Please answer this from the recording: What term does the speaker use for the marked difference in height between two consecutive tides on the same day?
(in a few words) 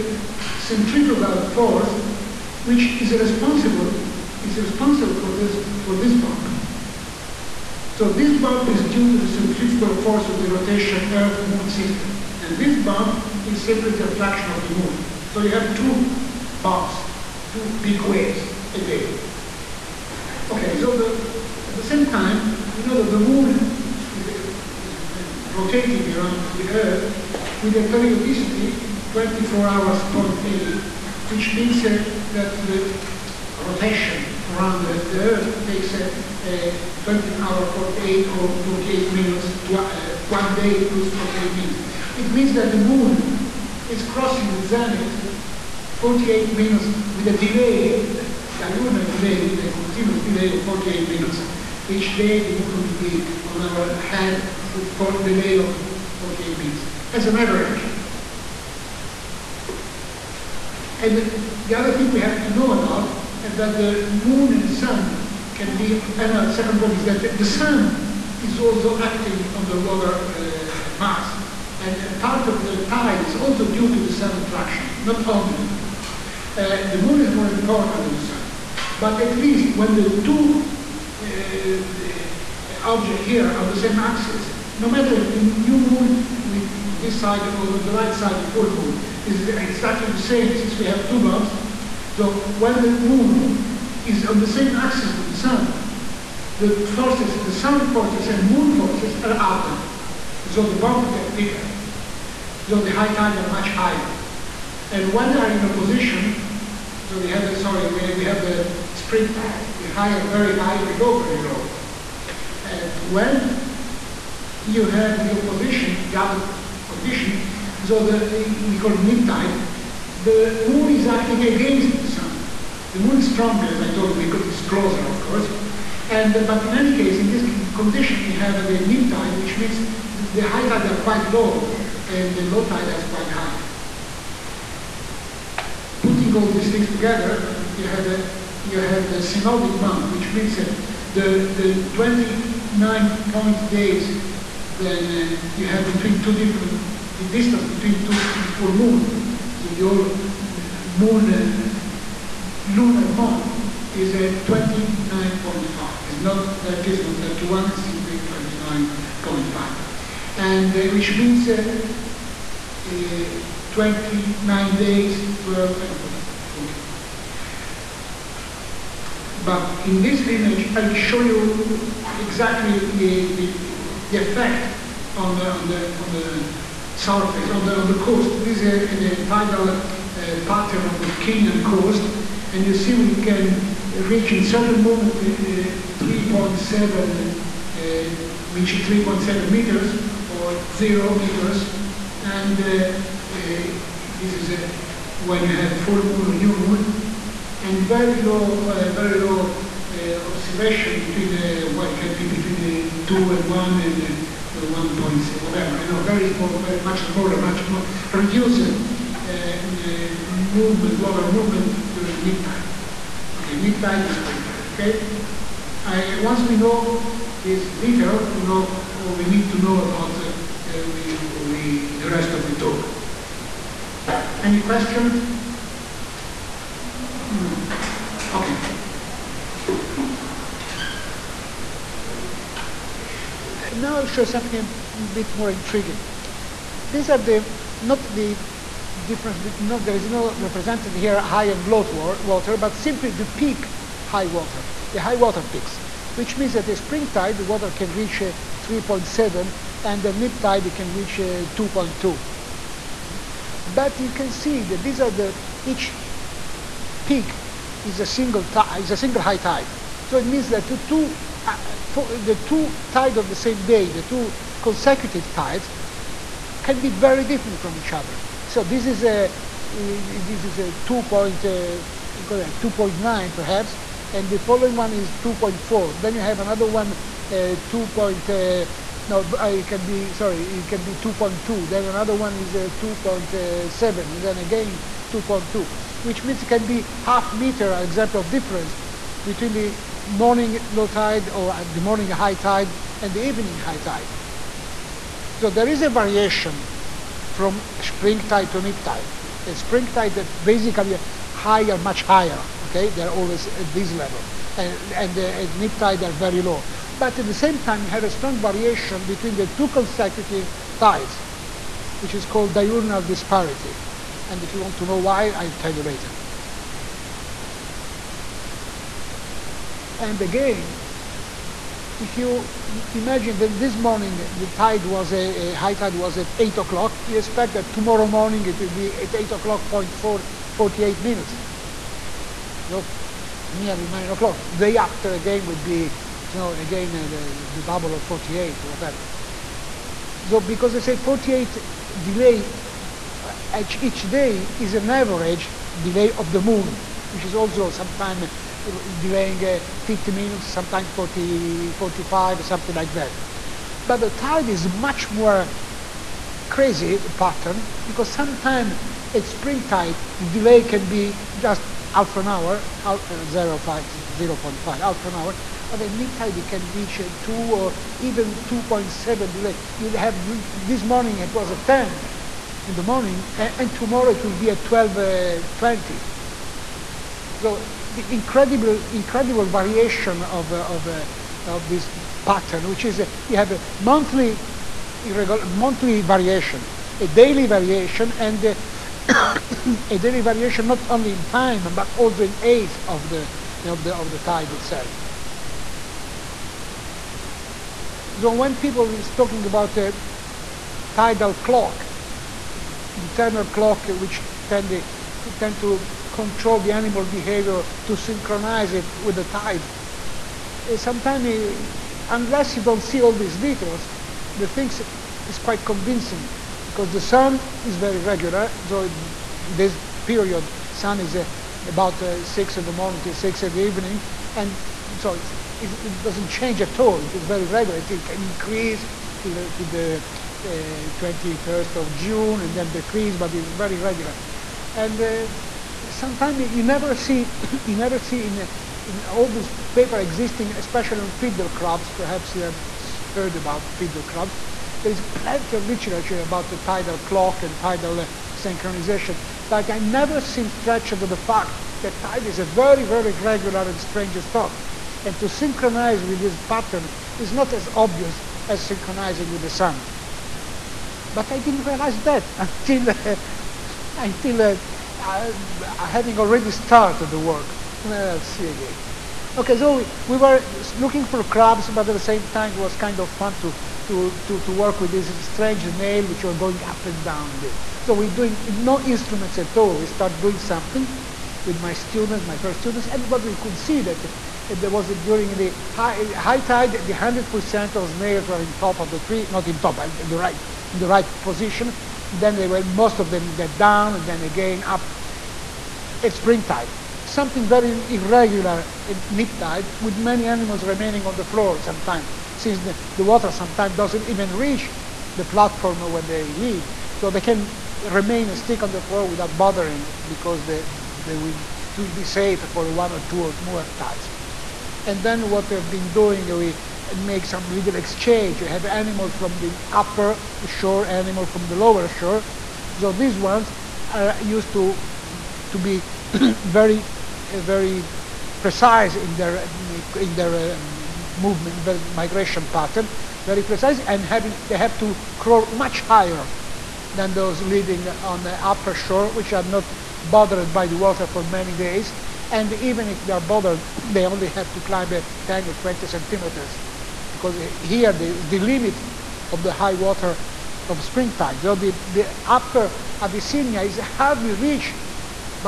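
diurnal disparity.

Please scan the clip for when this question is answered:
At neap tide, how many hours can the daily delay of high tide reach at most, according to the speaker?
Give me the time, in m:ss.
6:08.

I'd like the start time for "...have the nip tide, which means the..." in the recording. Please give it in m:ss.
2:08.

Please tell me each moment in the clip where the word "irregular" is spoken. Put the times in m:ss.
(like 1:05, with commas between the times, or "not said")
8:17.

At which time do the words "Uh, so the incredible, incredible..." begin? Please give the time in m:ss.
6:15.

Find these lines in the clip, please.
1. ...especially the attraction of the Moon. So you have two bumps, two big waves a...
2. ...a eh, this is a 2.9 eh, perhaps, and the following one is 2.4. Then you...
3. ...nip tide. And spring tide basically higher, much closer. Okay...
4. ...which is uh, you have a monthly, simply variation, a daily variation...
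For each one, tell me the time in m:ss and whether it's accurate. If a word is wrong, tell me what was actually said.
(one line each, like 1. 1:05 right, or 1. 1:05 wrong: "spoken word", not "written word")
1. 0:13 wrong: "simply", not "especially"
2. 4:29 right
3. 4:58 wrong: "higher", not "closer"
4. 6:22 wrong: "monthly", not "simply".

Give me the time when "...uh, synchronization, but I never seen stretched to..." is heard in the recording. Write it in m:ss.
7:28.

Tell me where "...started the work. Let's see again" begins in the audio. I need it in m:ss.
7:46.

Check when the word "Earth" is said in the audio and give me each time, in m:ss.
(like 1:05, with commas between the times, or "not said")
0:11, 0:26, 0:35.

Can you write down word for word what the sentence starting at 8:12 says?
Then they were, most of them get down and then again up at spring tide.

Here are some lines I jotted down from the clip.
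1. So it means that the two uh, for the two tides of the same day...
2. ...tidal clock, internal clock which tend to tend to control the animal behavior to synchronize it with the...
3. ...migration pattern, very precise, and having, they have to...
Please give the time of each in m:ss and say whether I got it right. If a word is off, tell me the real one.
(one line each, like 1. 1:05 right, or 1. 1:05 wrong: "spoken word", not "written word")
1. 4:20 right
2. 6:40 right
3. 8:51 right.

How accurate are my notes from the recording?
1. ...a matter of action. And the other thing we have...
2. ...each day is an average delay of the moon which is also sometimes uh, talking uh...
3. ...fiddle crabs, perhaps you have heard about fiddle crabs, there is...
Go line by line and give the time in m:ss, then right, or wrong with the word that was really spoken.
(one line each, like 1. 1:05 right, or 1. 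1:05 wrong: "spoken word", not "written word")
1. 0:57 right
2. 5:43 wrong: "delaying", not "talking"
3. 7:21 right.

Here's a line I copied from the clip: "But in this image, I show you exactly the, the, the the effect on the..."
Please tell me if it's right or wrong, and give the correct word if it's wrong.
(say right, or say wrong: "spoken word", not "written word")
right.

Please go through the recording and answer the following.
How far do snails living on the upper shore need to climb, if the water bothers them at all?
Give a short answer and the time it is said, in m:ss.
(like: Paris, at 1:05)
10 or 20 centimeters, at 9:04.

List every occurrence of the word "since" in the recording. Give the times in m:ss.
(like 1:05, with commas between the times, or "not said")
1:30, 8:22.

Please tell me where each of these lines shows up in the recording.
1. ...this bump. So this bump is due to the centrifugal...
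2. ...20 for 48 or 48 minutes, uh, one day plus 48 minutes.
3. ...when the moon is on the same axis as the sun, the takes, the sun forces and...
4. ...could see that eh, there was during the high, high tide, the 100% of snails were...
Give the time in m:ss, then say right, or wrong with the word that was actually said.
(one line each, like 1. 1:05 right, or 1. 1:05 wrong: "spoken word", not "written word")
1. 0:05 right
2. 0:37 right
3. 1:32 wrong: "forces", not "takes"
4. 8:03 right.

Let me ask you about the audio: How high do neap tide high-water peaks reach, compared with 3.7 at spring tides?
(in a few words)
2.2.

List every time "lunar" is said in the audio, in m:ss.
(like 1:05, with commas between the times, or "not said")
0:48, 2:32.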